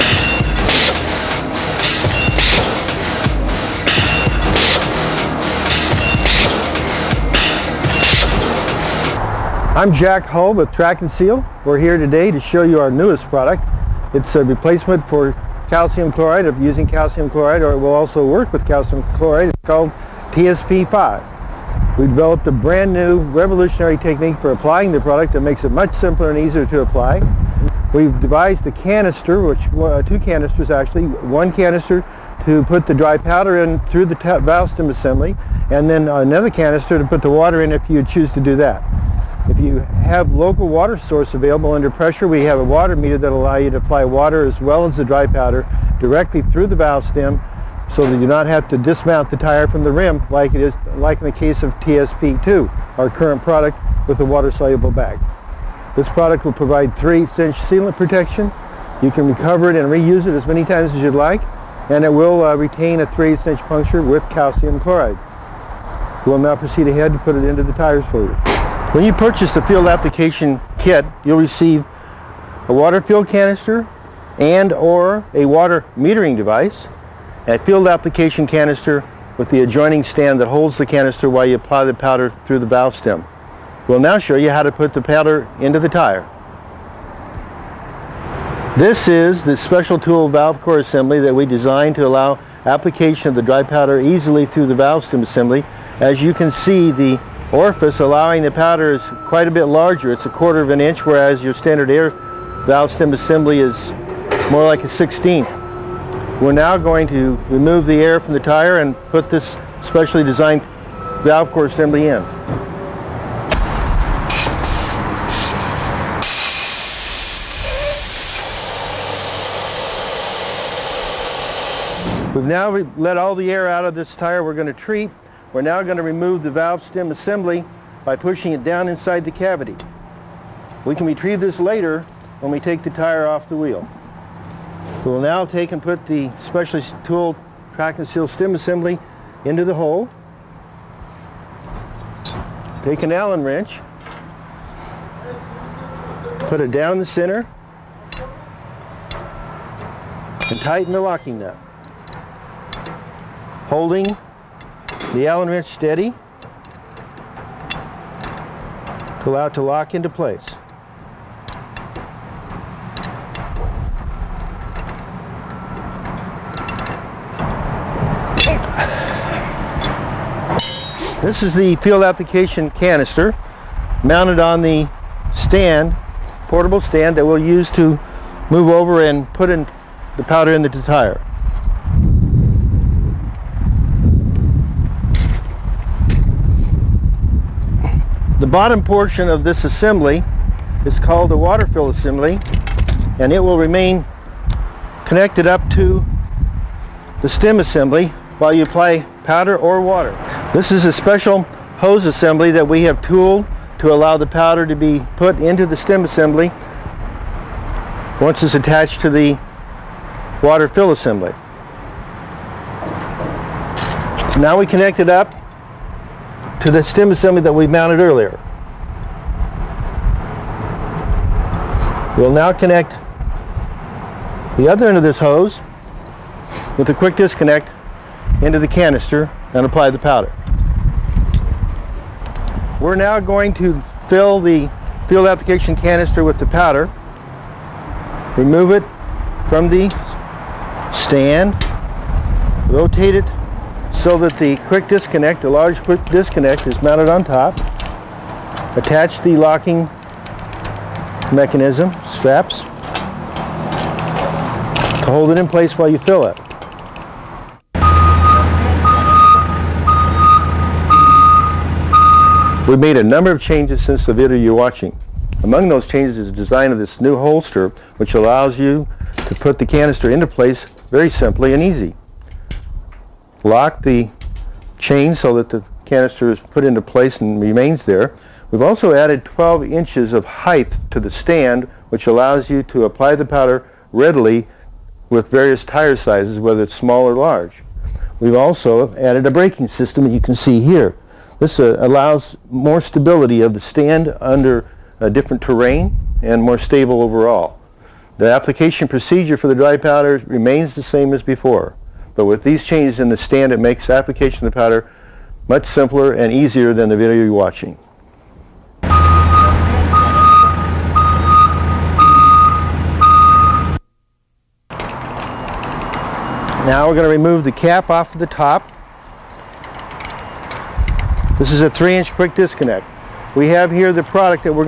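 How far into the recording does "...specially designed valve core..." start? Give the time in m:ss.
1:49.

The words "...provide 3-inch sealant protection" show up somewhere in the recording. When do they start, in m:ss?
0:56.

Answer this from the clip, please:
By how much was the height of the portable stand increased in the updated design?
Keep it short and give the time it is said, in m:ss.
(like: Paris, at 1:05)
12 inches, at 4:39.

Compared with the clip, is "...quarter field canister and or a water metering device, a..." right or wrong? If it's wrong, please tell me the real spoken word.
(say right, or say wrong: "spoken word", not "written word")
wrong: "water", not "quarter".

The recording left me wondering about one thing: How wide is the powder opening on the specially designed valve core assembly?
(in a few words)
a quarter of an inch.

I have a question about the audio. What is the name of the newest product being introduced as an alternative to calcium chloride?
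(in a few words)
TSP5.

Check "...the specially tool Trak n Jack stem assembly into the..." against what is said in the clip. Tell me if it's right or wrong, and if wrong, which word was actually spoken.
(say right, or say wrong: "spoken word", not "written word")
wrong: "Seal", not "Jack".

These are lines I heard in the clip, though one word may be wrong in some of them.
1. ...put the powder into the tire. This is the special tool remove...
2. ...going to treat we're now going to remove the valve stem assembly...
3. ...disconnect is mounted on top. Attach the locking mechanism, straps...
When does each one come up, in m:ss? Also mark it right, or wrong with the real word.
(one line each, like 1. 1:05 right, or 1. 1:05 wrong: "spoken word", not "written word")
1. 1:24 wrong: "valve", not "remove"
2. 2:04 right
3. 4:06 right.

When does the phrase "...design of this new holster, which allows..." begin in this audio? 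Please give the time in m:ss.
4:26.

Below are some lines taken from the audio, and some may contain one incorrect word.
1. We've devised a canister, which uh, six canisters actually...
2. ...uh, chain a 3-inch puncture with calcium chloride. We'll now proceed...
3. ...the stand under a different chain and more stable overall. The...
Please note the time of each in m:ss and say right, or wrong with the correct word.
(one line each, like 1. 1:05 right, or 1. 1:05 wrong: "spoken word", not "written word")
1. 0:27 wrong: "two", not "six"
2. 1:02 wrong: "retain", not "chain"
3. 4:53 wrong: "terrain", not "chain".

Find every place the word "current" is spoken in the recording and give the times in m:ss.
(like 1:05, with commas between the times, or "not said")
0:53.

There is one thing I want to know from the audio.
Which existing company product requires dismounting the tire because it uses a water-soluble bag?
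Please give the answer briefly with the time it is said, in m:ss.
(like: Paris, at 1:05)
TSP2, at 0:51.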